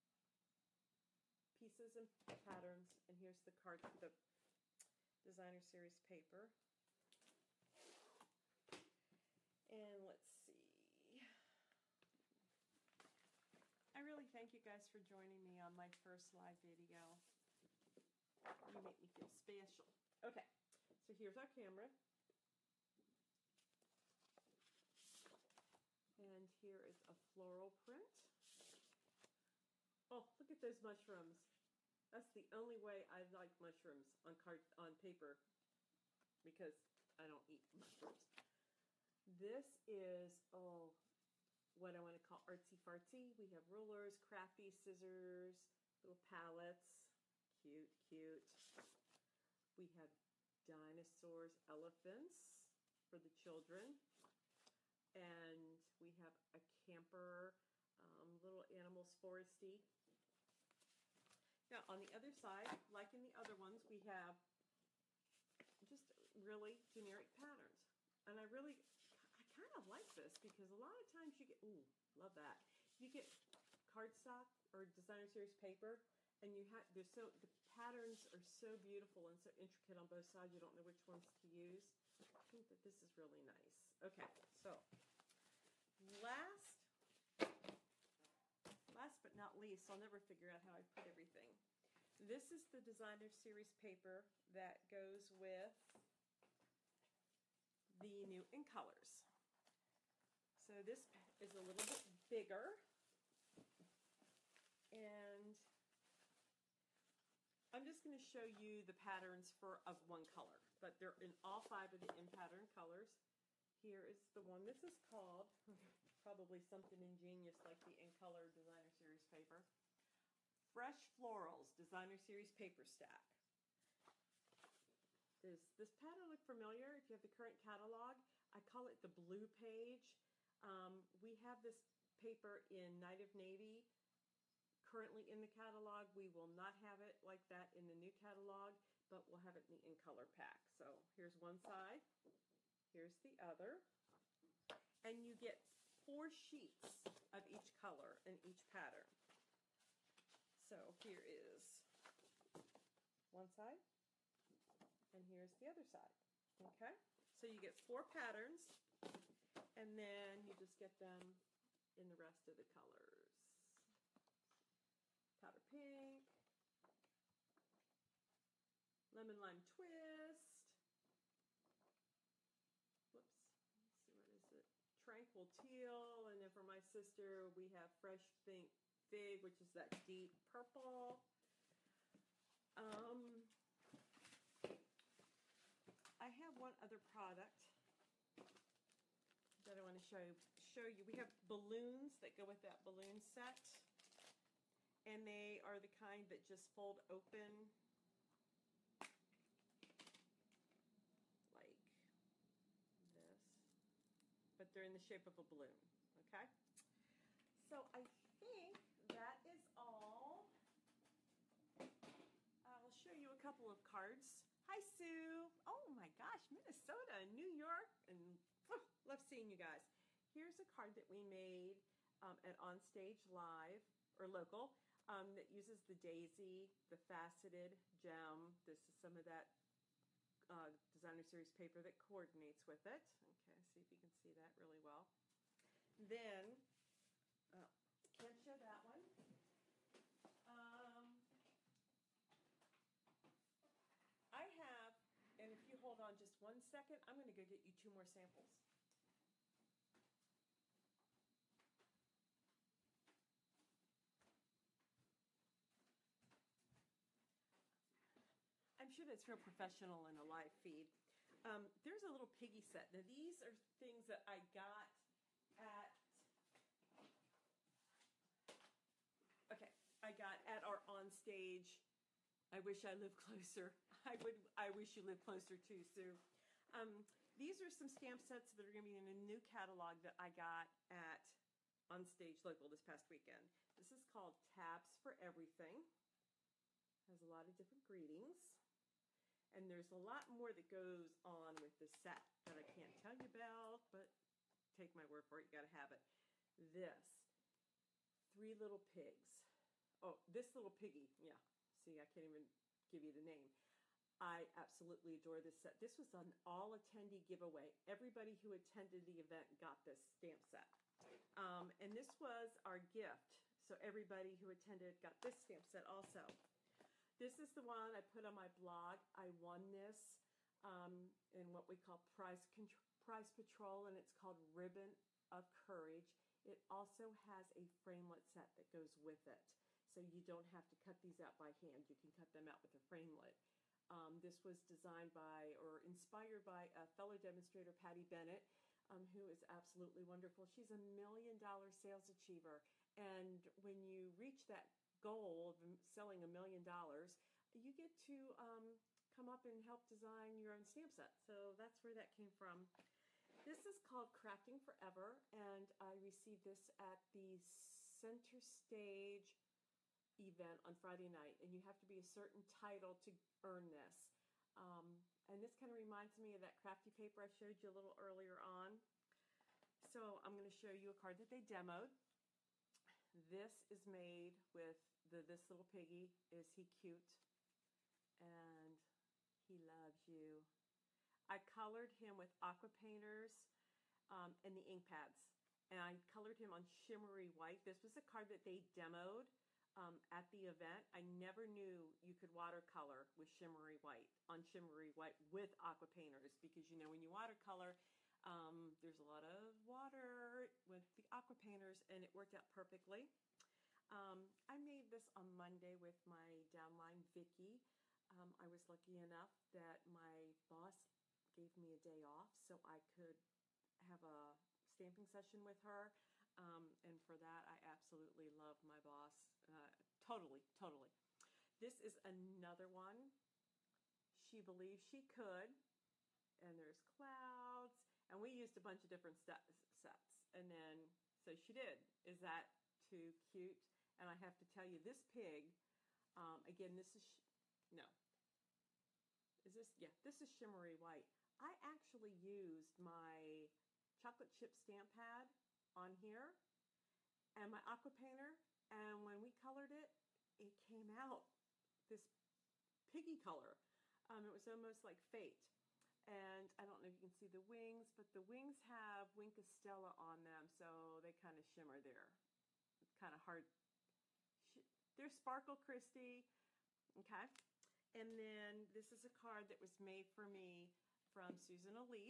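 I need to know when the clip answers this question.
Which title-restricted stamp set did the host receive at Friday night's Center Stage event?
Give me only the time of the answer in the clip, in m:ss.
5:54.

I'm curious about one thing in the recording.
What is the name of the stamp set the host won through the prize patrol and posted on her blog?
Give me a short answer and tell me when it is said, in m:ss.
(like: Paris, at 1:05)
Ribbon of Courage, at 5:24.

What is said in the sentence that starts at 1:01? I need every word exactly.
Now on the other side, like in the other ones, we have just really generic patterns.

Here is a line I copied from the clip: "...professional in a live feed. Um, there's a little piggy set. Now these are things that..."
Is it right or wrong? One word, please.
right.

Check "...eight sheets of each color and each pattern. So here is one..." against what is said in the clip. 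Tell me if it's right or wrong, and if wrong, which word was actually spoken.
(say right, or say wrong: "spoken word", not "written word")
wrong: "four", not "eight".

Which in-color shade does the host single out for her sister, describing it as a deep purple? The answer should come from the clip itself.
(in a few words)
Fresh Pink Fig.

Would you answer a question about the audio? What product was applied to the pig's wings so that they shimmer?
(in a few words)
Wink of Stella.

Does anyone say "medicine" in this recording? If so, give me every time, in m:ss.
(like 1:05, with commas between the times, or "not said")
not said.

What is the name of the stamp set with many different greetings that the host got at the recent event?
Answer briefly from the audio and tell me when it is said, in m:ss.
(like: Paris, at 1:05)
Tabs for Everything, at 4:44.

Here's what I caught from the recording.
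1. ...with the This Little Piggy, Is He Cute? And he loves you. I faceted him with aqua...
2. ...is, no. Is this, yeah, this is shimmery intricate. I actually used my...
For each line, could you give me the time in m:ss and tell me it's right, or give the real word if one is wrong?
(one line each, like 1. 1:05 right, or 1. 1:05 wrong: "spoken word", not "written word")
1. 6:14 wrong: "colored", not "faceted"
2. 7:16 wrong: "white", not "intricate".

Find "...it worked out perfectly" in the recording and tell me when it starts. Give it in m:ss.
6:42.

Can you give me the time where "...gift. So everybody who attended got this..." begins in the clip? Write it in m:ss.
5:12.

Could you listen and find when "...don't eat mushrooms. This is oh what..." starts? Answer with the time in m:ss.
0:37.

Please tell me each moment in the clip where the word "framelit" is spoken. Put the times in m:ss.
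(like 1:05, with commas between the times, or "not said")
5:27, 5:32.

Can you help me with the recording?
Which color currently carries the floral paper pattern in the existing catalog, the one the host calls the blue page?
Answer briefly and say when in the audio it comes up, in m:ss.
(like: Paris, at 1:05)
Night of Navy, at 2:12.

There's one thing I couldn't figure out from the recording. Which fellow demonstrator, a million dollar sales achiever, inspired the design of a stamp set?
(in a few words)
Patty Bennett.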